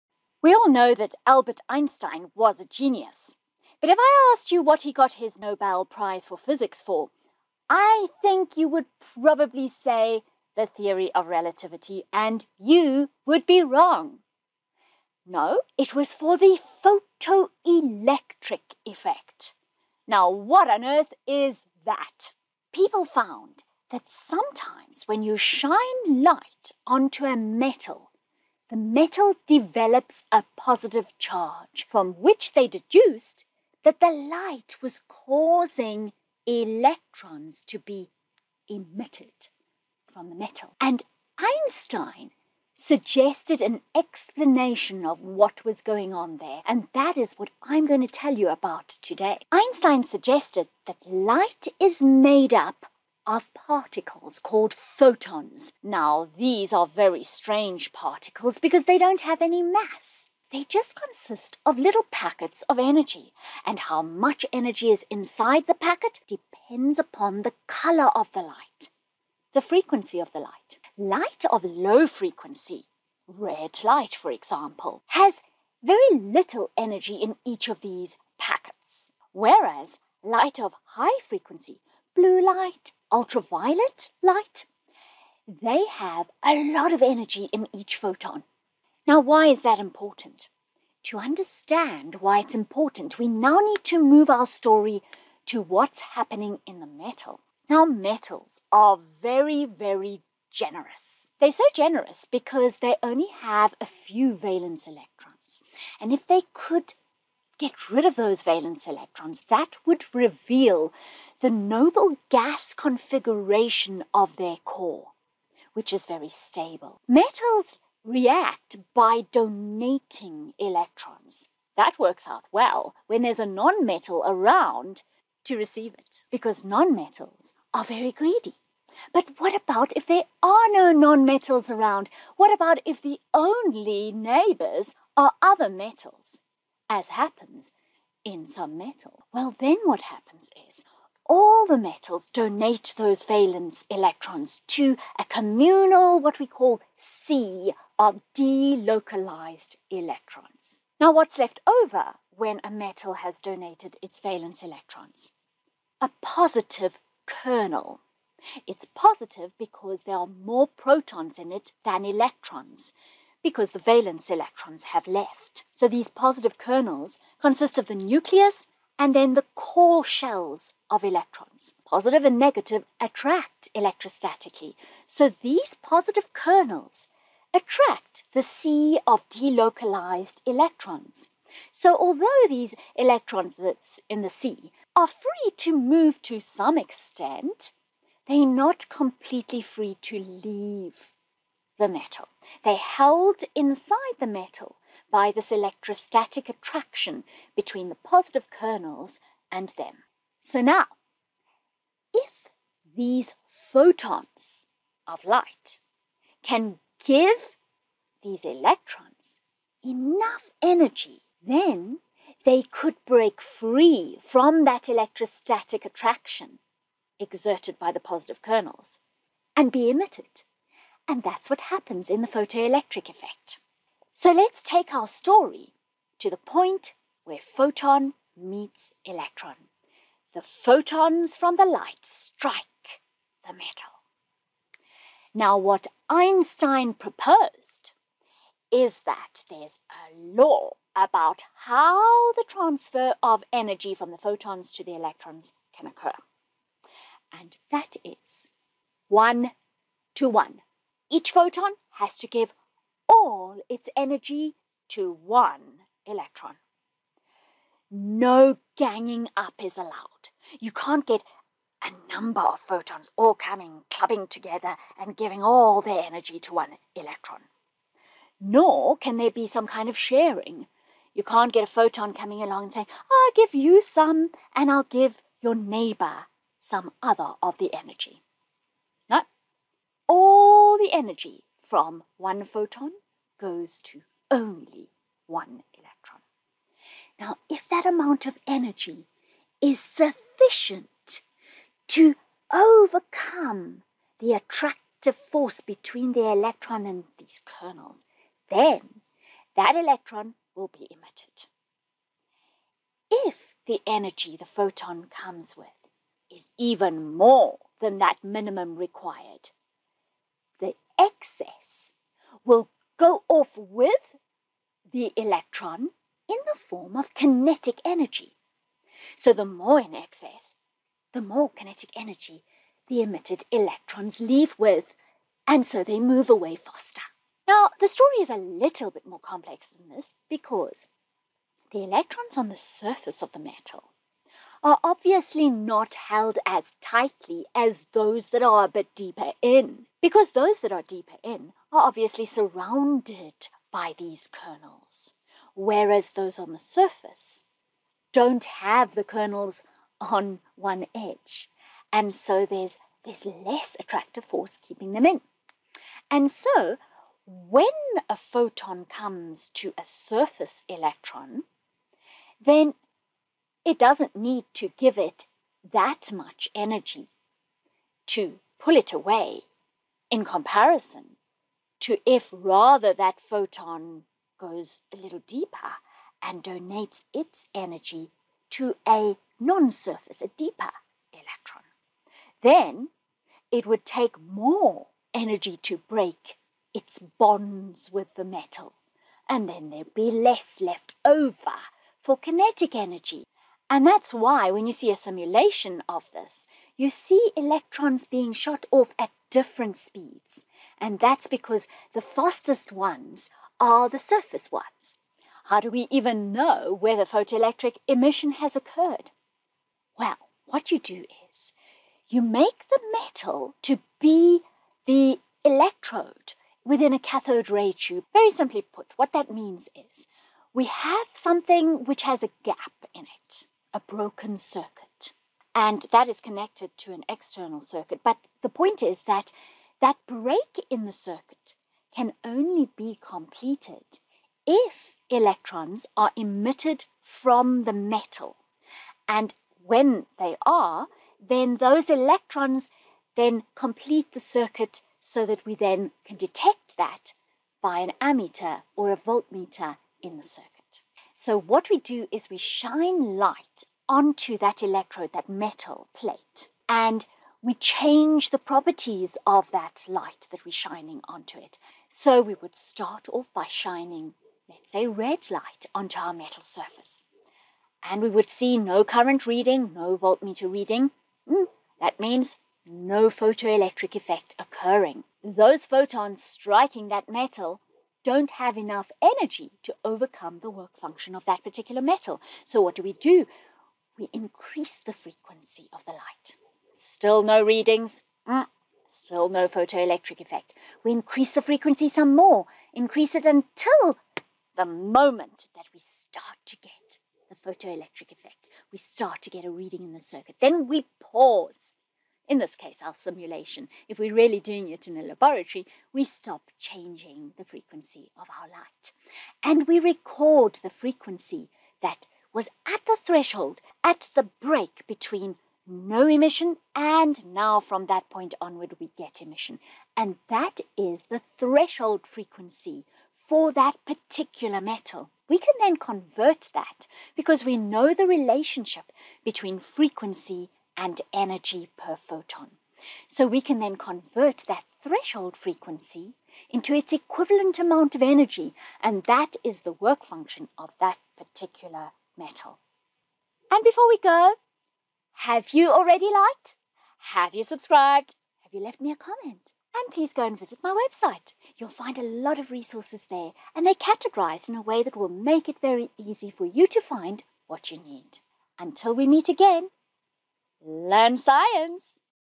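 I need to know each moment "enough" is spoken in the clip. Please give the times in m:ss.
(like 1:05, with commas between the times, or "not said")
3:29, 7:58.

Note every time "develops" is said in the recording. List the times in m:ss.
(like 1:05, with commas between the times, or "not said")
0:29.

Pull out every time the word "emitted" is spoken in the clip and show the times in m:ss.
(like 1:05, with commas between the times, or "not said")
0:38, 3:39, 5:00, 5:23, 7:16.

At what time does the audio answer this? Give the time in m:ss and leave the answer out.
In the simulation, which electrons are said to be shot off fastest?
6:43.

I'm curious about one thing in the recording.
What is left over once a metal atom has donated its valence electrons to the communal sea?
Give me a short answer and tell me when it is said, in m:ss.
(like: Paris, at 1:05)
A positive kernel, at 2:36.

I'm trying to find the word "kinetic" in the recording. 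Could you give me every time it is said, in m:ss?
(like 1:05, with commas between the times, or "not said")
5:17, 5:21, 6:32.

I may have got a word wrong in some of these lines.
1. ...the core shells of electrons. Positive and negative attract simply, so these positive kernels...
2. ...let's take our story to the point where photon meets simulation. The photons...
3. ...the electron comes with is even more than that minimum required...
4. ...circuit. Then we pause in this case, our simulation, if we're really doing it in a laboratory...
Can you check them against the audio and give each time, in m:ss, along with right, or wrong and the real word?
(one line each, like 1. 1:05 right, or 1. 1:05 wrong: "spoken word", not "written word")
1. 2:49 wrong: "electrostatically", not "simply"
2. 3:44 wrong: "electron", not "simulation"
3. 5:04 wrong: "photon", not "electron"
4. 8:20 right.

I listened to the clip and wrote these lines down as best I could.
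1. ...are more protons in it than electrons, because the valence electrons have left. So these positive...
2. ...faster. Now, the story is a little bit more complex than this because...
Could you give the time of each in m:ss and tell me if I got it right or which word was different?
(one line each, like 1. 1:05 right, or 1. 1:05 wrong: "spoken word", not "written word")
1. 2:40 right
2. 5:26 right.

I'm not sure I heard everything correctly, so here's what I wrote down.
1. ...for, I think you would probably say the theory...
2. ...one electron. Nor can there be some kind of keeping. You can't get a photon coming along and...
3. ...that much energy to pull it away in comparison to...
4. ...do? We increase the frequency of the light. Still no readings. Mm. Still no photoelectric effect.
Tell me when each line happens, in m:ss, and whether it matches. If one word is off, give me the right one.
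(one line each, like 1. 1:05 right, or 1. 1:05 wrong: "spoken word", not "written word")
1. 0:06 right
2. 4:26 wrong: "sharing", not "keeping"
3. 6:05 right
4. 8:02 right.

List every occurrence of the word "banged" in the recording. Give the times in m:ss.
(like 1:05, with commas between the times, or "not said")
not said.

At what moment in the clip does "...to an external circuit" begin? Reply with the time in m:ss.
7:06.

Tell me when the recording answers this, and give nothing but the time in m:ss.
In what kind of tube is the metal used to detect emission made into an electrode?
6:56.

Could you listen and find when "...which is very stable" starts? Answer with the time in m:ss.
1:55.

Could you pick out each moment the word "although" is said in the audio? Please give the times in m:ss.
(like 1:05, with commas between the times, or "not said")
3:01.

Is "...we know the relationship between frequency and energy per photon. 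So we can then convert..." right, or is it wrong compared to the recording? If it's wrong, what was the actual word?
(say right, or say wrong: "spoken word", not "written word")
right.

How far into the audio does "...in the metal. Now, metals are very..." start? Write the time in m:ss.
1:36.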